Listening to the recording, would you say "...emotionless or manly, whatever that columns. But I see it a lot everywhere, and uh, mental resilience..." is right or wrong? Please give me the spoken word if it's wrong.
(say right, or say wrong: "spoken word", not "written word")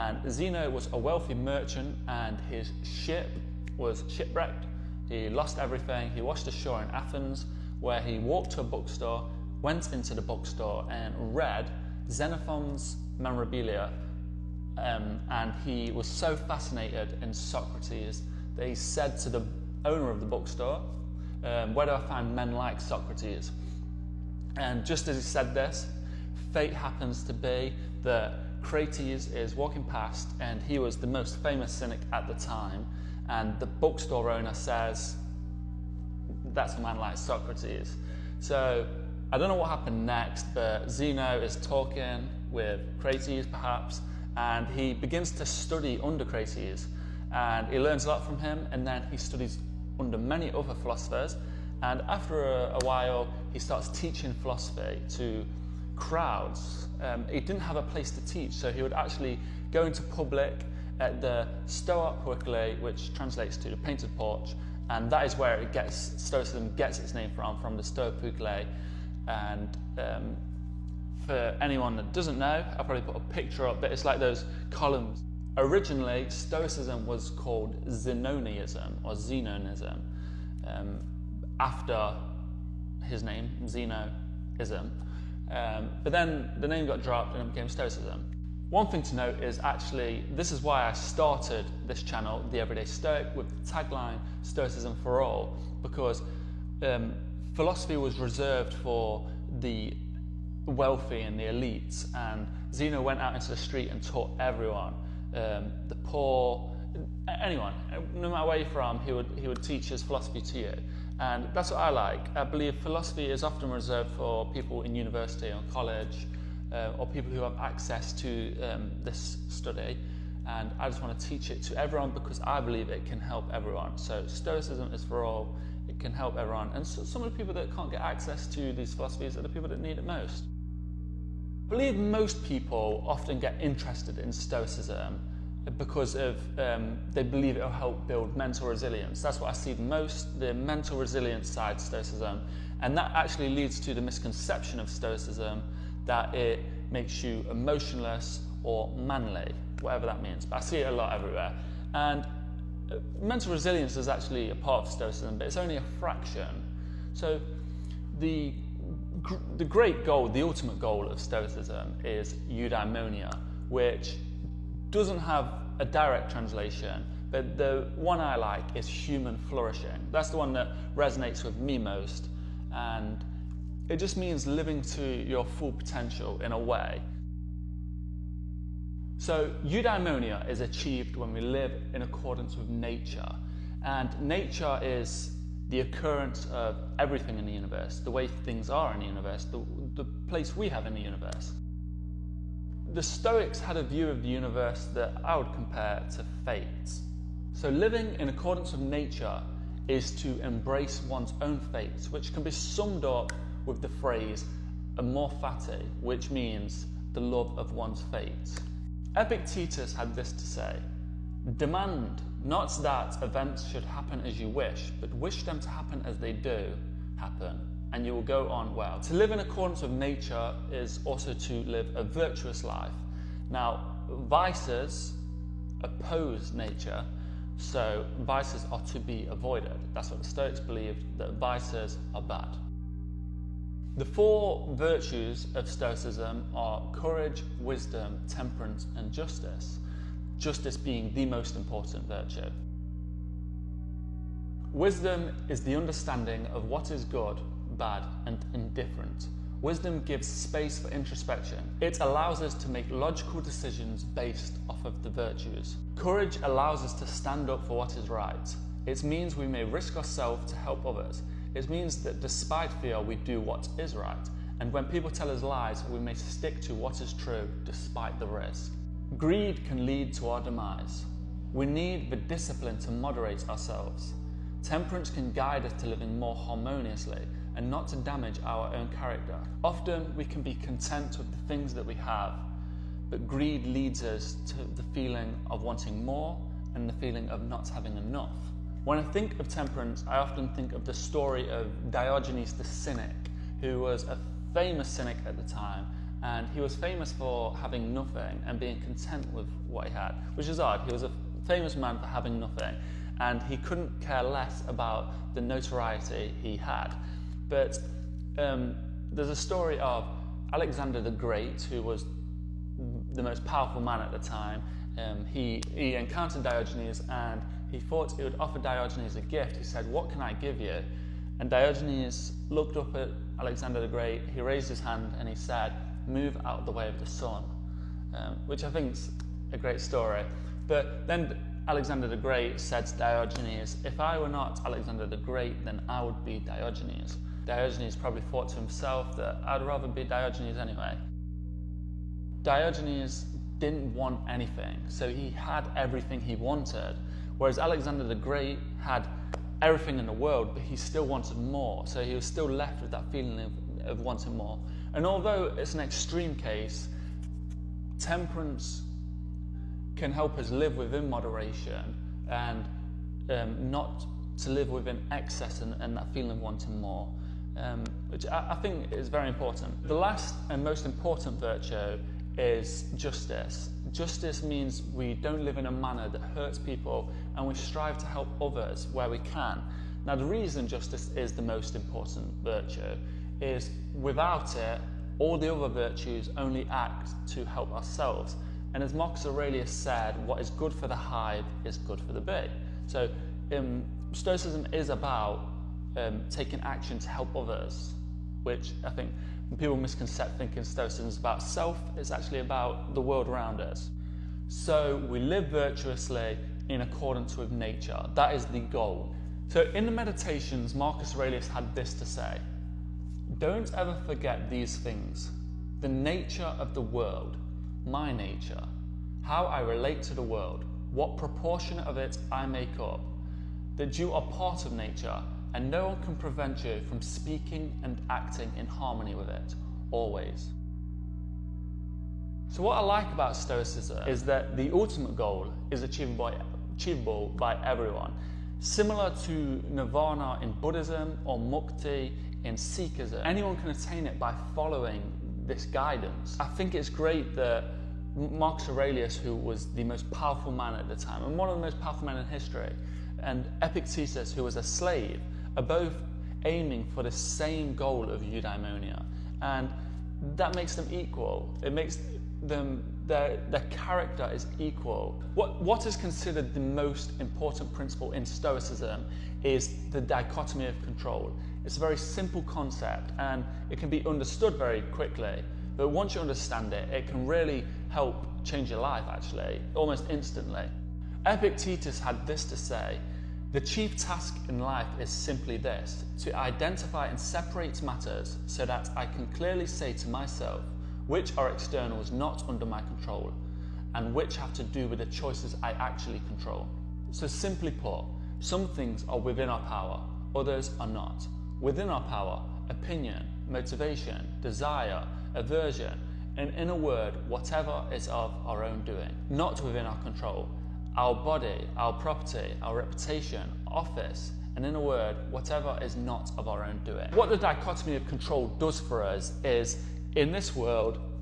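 wrong: "means", not "columns".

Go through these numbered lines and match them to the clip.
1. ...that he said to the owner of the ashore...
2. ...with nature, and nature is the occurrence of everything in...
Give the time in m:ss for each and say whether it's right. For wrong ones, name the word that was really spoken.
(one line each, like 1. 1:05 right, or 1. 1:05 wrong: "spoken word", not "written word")
1. 0:18 wrong: "bookstore", not "ashore"
2. 3:02 right.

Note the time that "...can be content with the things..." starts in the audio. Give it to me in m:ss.
4:40.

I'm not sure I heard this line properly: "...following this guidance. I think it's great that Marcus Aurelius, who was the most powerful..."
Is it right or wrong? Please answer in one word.
right.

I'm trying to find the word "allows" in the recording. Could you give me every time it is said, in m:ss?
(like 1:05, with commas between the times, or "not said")
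4:11, 4:16.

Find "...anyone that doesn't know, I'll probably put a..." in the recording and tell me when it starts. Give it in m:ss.
1:11.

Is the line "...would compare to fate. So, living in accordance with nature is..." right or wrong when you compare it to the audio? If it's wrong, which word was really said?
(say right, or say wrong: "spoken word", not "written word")
right.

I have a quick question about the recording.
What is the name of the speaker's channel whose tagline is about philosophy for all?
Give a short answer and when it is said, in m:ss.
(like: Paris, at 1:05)
The Everyday Stoic, at 1:32.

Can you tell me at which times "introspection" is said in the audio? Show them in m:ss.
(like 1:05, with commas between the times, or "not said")
4:10.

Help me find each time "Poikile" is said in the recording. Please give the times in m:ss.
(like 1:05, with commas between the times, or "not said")
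1:02, 1:08.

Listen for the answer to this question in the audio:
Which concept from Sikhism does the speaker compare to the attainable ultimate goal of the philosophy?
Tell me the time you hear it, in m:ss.
7:21.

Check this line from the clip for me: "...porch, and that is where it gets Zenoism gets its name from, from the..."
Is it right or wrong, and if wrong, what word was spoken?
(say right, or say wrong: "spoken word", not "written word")
wrong: "Stoicism", not "Zenoism".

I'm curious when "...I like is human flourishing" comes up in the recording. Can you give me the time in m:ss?
2:48.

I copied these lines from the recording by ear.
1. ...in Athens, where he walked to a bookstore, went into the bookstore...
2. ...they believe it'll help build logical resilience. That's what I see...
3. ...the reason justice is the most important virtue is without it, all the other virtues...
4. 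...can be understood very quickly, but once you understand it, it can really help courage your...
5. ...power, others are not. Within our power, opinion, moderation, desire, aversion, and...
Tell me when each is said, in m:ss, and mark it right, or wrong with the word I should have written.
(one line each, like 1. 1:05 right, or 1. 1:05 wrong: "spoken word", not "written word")
1. 0:06 right
2. 2:17 wrong: "mental", not "logical"
3. 6:20 right
4. 7:53 wrong: "change", not "courage"
5. 8:19 wrong: "motivation", not "moderation".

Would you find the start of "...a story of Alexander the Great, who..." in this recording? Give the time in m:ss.
5:09.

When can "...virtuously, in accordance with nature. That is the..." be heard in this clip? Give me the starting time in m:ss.
6:45.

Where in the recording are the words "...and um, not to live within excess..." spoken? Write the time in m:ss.
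6:02.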